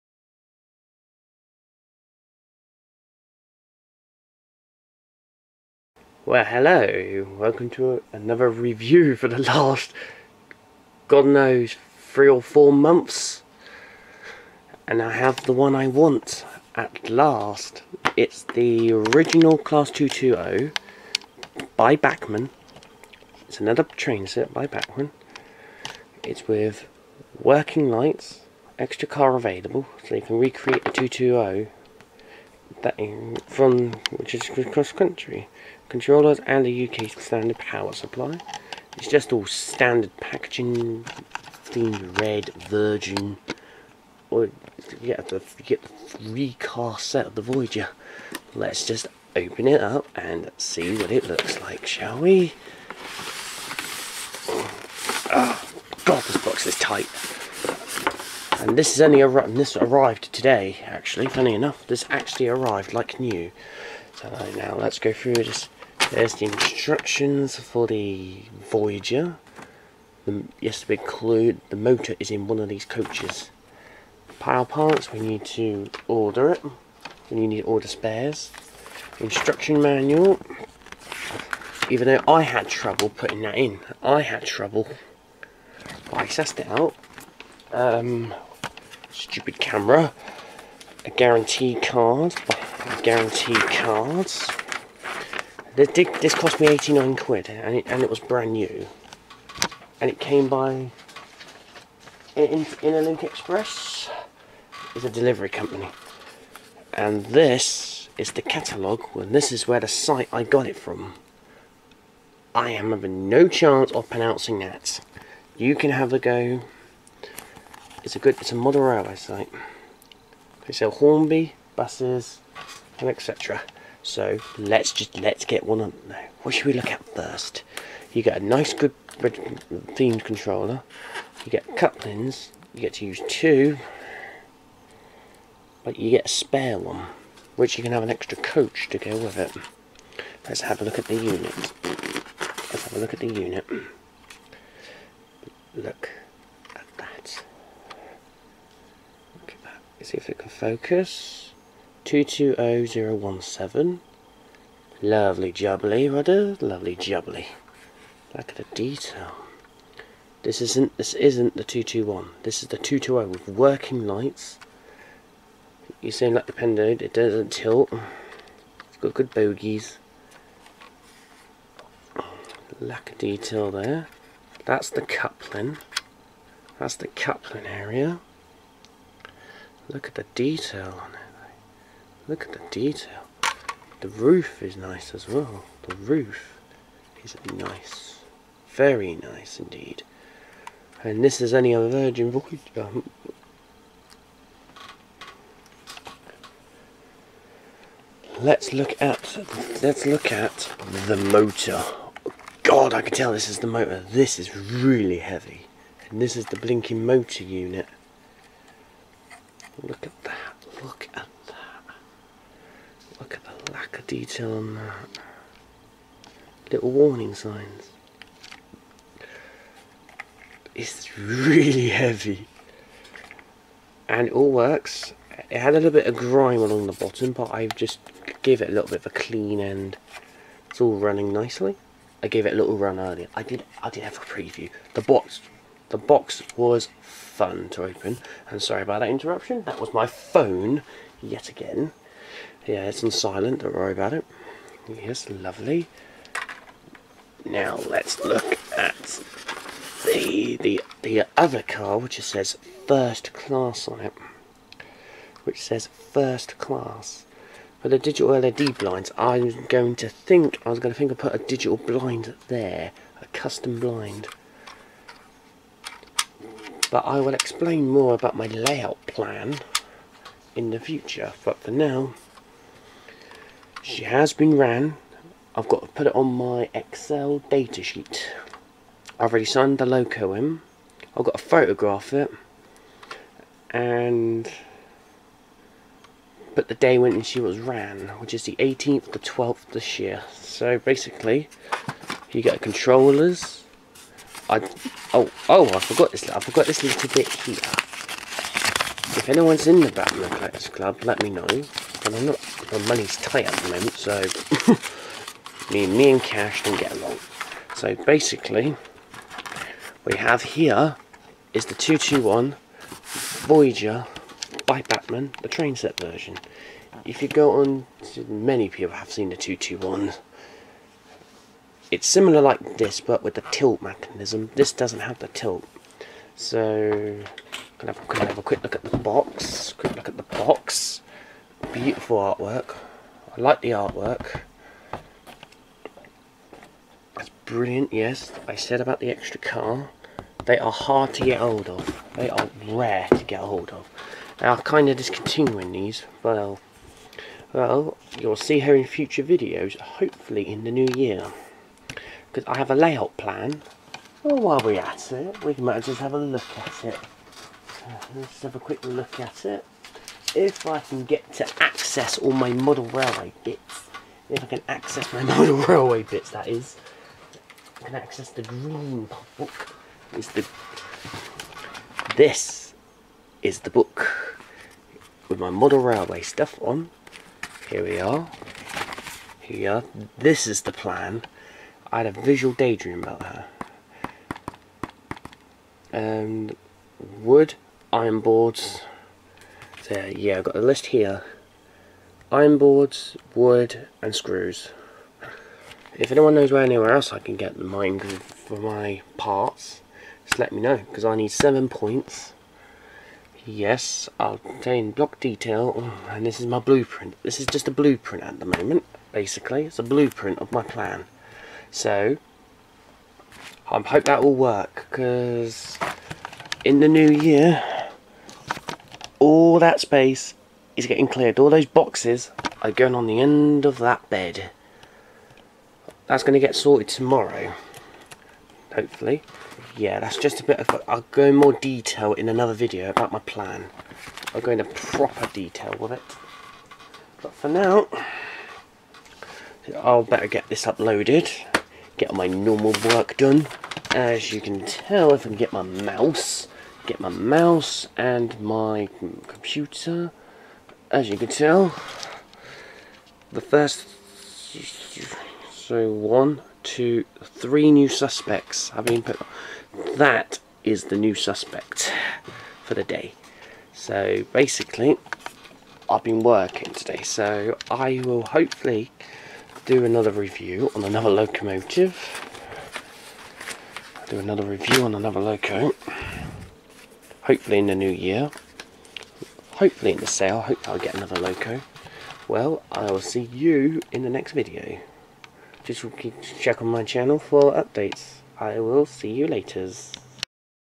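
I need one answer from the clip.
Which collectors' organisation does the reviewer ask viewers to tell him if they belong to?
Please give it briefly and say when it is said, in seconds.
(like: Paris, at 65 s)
Bachmann Collectors Club, at 299 s.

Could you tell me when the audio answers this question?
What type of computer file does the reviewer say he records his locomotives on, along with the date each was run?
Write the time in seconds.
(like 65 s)
276 s.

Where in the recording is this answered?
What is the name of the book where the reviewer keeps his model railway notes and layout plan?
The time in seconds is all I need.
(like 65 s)
368 s.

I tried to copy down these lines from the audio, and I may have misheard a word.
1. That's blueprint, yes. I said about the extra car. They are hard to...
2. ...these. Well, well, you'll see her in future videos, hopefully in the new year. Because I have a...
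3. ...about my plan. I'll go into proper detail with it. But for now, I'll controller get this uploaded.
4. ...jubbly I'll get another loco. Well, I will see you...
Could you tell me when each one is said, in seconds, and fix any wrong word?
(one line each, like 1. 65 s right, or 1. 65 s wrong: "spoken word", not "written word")
1. 337 s wrong: "brilliant", not "blueprint"
2. 345 s right
3. 432 s wrong: "better", not "controller"
4. 480 s wrong: "hopefully", not "jubbly".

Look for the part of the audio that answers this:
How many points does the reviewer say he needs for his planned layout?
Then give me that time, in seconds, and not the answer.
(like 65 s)
401 s.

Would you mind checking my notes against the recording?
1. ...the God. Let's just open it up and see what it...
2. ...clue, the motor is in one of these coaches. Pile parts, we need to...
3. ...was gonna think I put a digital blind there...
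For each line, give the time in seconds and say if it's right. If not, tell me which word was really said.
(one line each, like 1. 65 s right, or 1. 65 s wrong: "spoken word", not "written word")
1. 47 s wrong: "Voyager", not "God"
2. 71 s right
3. 260 s right.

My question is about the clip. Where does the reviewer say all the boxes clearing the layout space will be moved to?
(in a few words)
the end of that bed.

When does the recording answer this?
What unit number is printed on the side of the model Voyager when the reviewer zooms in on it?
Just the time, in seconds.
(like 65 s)
152 s.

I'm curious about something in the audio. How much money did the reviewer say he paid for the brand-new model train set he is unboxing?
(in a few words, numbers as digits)
89 quid.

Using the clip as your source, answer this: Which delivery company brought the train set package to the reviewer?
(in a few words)
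Link Express.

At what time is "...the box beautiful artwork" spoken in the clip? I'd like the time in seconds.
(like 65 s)
330 s.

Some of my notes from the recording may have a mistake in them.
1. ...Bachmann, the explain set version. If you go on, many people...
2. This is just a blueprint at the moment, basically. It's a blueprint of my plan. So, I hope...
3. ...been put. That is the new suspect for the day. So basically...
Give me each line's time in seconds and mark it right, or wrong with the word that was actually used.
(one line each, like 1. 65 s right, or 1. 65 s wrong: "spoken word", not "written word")
1. 314 s wrong: "train", not "explain"
2. 407 s right
3. 458 s right.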